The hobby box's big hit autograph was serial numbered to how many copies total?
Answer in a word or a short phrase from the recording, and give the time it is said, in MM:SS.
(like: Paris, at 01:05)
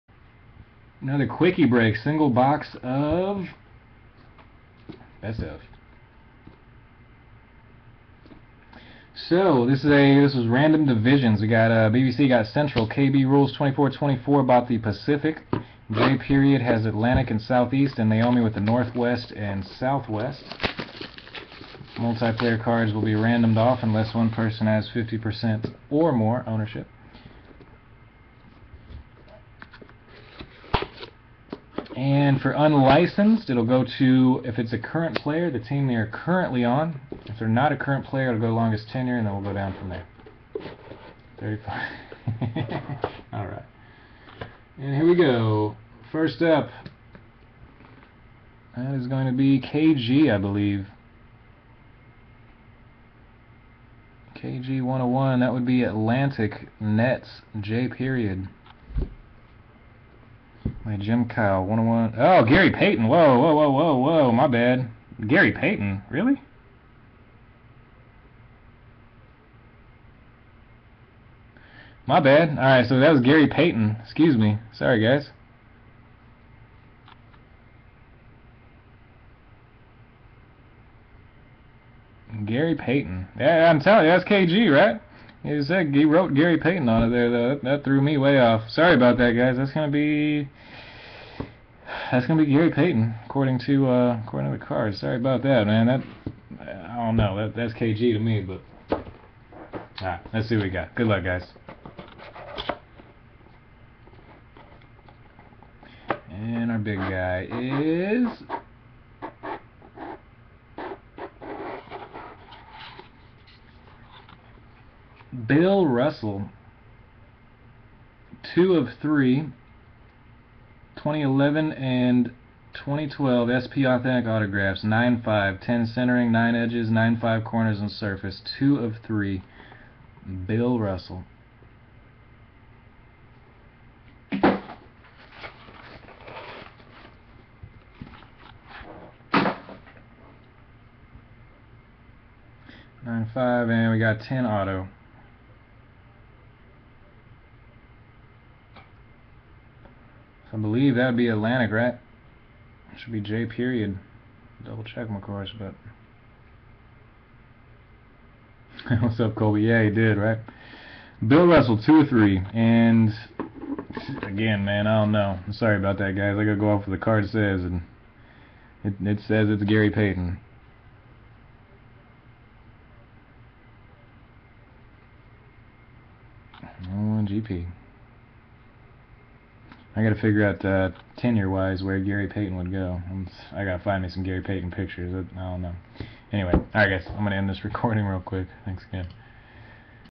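3, at 01:59.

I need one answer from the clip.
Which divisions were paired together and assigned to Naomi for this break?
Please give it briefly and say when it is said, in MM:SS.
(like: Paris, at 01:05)
Northwest and Southwest, at 00:18.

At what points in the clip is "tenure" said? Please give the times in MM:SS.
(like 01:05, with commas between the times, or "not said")
00:38, 03:01.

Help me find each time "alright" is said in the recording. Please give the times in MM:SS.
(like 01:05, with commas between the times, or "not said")
01:12, 03:06.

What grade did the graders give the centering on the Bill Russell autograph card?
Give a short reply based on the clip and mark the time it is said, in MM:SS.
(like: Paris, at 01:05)
10, at 02:05.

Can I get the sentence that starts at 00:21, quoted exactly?
Multiplayer cards will be randomed off unless one person has 50% or more ownership.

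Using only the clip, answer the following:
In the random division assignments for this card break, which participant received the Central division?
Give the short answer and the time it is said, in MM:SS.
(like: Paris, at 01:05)
BBC, at 00:11.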